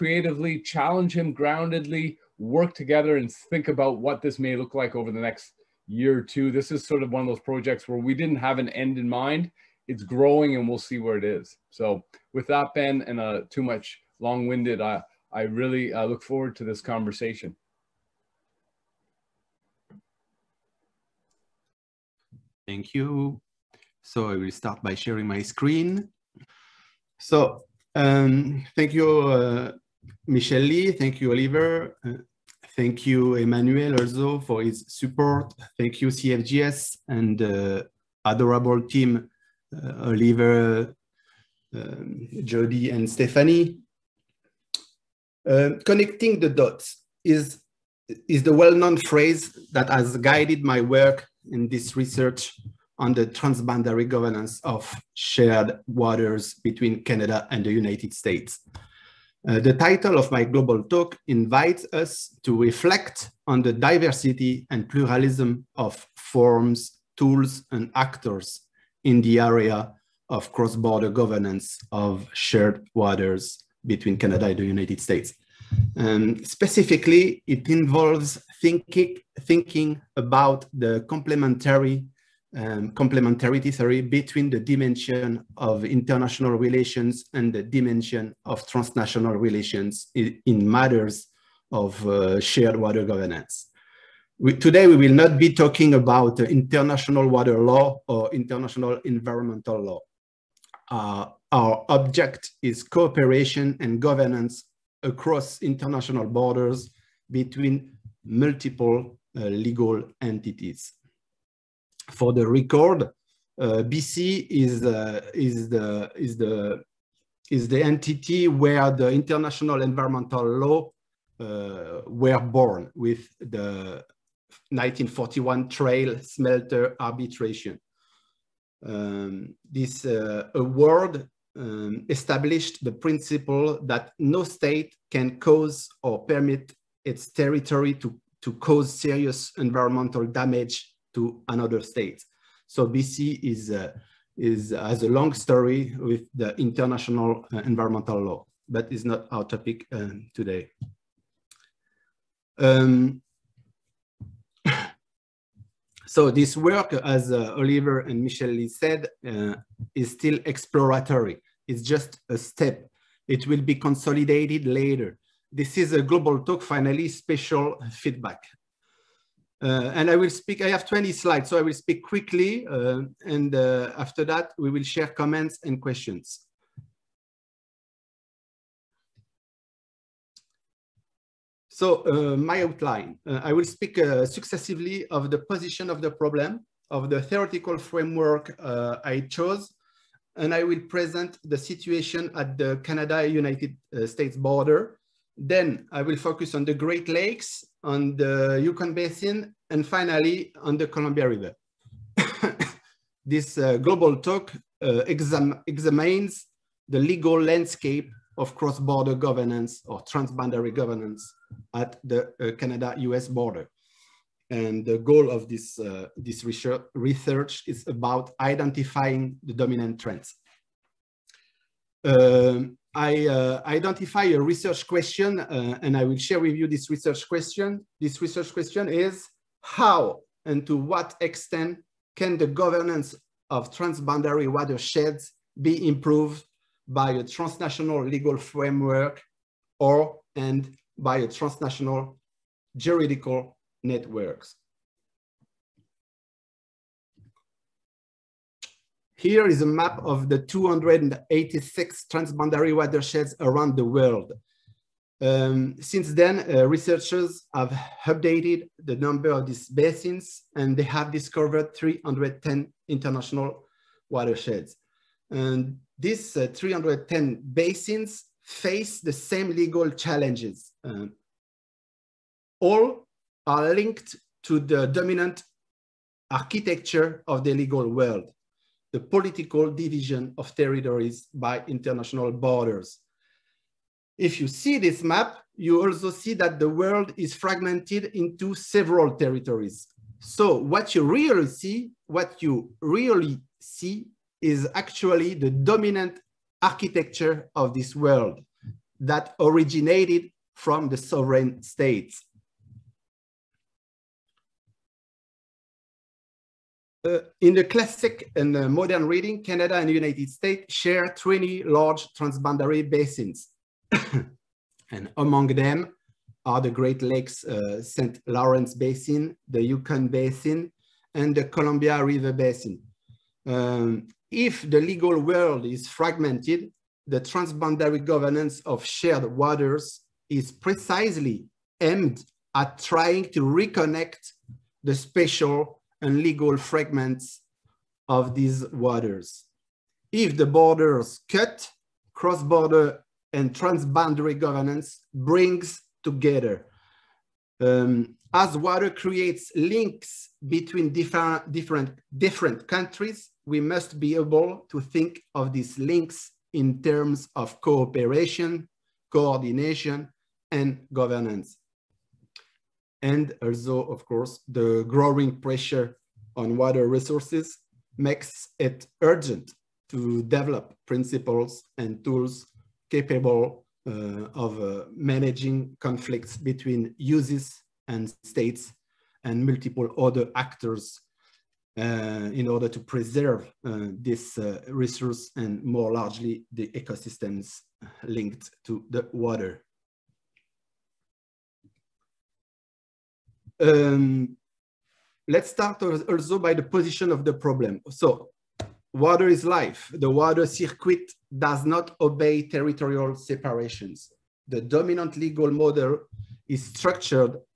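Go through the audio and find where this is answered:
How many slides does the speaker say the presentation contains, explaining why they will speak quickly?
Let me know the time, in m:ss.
2:50.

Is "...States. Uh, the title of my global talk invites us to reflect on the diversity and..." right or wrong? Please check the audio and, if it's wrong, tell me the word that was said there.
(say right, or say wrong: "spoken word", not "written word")
right.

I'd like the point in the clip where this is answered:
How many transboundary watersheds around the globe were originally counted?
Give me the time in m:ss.
4:10.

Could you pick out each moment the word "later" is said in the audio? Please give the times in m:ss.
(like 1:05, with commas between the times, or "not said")
2:44.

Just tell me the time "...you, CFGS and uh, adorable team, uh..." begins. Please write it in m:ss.
0:36.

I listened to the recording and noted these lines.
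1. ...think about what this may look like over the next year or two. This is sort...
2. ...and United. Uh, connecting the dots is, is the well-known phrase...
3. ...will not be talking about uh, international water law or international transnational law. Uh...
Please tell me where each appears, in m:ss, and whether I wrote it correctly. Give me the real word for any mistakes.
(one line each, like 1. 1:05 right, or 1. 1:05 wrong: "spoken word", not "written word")
1. 0:03 right
2. 0:42 wrong: "Stephanie", not "United"
3. 1:34 wrong: "environmental", not "transnational".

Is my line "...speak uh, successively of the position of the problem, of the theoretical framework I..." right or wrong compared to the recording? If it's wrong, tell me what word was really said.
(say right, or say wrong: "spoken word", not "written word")
right.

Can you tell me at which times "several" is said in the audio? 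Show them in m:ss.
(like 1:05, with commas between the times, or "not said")
4:48.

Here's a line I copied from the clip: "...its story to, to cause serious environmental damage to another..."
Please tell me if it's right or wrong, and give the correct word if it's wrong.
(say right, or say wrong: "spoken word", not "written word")
wrong: "territory", not "story".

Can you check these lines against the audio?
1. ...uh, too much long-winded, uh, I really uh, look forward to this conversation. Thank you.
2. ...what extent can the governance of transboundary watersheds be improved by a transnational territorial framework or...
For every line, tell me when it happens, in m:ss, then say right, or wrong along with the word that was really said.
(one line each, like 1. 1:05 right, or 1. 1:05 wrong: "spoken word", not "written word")
1. 0:13 right
2. 3:50 wrong: "legal", not "territorial".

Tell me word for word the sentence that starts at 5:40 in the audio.
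If the borders cut, cross-border and transboundary governance brings together.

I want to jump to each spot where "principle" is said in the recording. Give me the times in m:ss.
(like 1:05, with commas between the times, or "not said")
2:12, 6:10.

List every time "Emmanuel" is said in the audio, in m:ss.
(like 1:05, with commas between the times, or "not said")
0:33.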